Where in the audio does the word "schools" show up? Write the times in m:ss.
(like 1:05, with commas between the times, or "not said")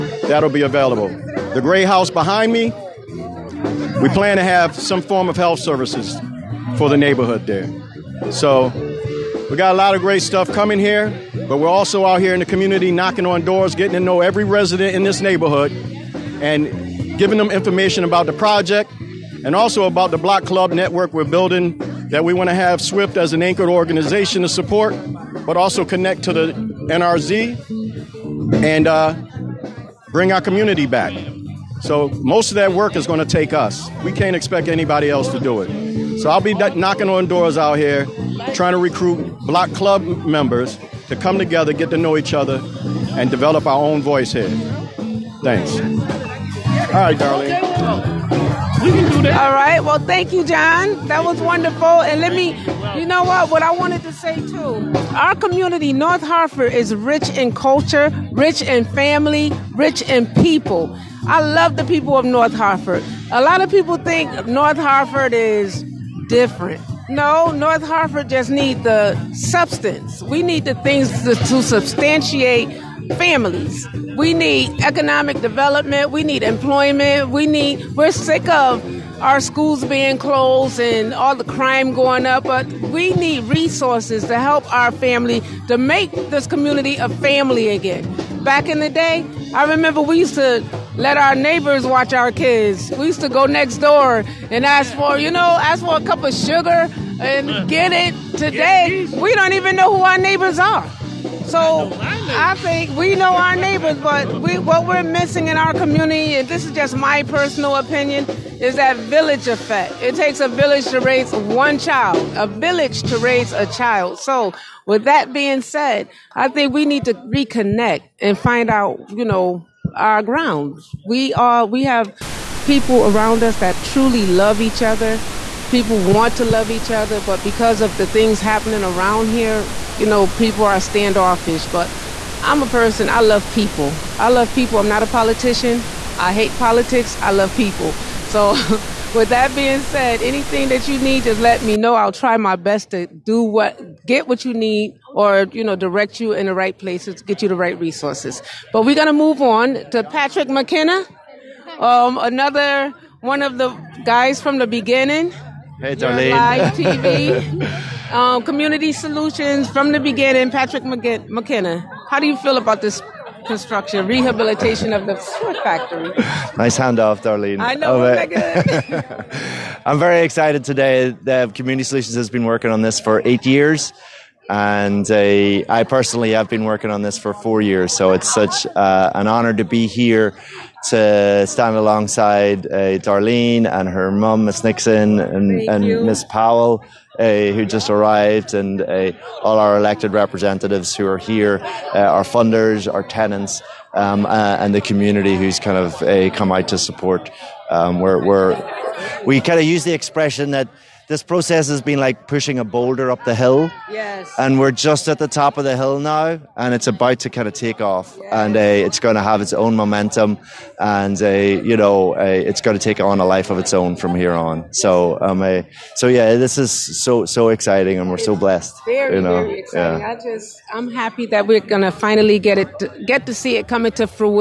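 1:19.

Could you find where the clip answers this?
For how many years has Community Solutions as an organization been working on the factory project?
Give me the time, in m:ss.
2:53.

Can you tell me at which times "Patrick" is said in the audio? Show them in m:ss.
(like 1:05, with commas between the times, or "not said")
2:30, 2:40.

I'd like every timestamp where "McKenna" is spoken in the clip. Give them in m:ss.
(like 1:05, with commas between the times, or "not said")
2:30, 2:40.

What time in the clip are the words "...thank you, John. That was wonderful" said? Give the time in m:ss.
0:49.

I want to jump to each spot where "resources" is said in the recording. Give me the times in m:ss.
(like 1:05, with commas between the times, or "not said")
1:23, 2:27.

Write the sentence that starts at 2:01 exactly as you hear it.
We are, we have people around us that truly love each other.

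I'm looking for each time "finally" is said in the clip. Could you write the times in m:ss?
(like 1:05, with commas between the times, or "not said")
3:41.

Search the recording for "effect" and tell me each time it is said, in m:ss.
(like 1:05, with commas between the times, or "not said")
1:49.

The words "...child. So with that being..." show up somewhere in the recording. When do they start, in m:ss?
1:53.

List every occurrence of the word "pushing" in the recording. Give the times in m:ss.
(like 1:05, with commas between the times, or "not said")
3:22.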